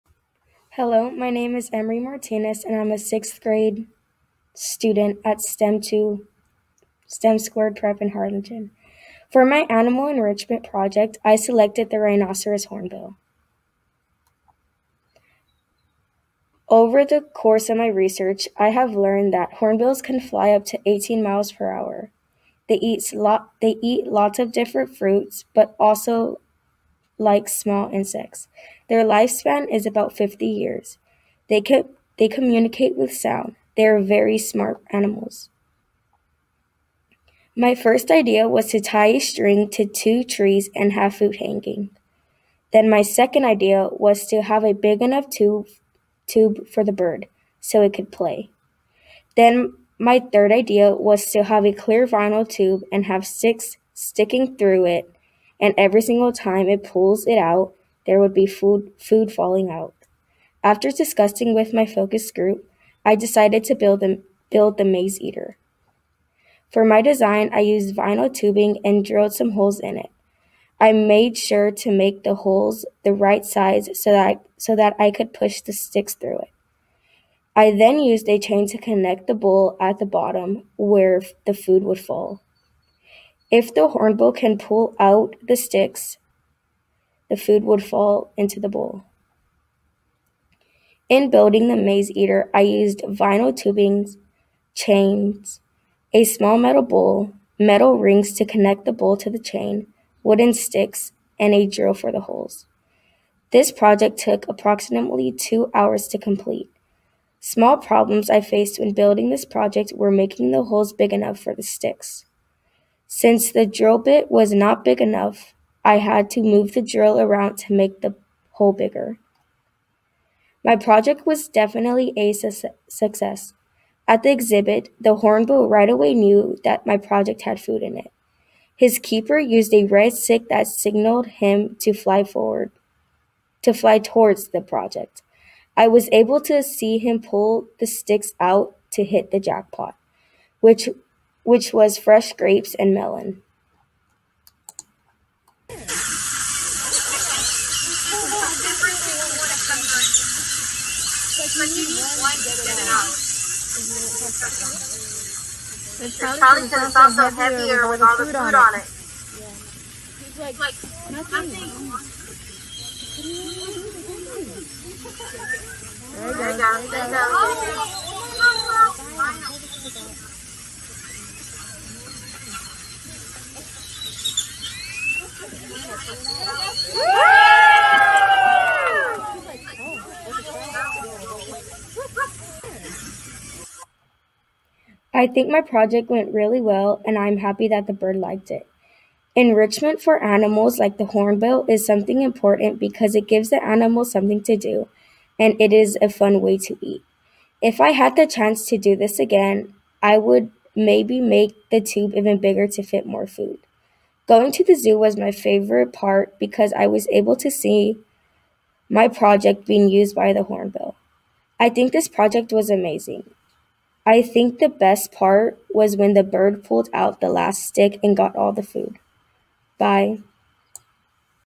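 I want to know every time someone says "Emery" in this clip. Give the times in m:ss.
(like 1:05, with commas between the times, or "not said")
0:01.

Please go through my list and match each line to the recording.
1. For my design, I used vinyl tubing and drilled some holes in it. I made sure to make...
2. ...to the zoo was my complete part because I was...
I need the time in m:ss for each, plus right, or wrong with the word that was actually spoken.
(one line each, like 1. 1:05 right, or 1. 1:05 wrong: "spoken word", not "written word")
1. 1:06 right
2. 3:24 wrong: "favorite", not "complete".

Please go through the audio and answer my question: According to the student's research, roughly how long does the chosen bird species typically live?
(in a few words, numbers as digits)
50 years.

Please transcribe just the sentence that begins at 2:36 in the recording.
It's probably because it's also heavier with all the food on On it.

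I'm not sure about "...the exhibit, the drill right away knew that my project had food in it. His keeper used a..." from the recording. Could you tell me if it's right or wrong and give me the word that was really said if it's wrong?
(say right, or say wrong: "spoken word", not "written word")
wrong: "hornbill", not "drill".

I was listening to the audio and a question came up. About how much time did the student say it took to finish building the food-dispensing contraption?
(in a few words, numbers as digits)
2 hours.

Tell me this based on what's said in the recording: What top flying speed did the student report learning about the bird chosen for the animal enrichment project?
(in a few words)
18 miles per hour.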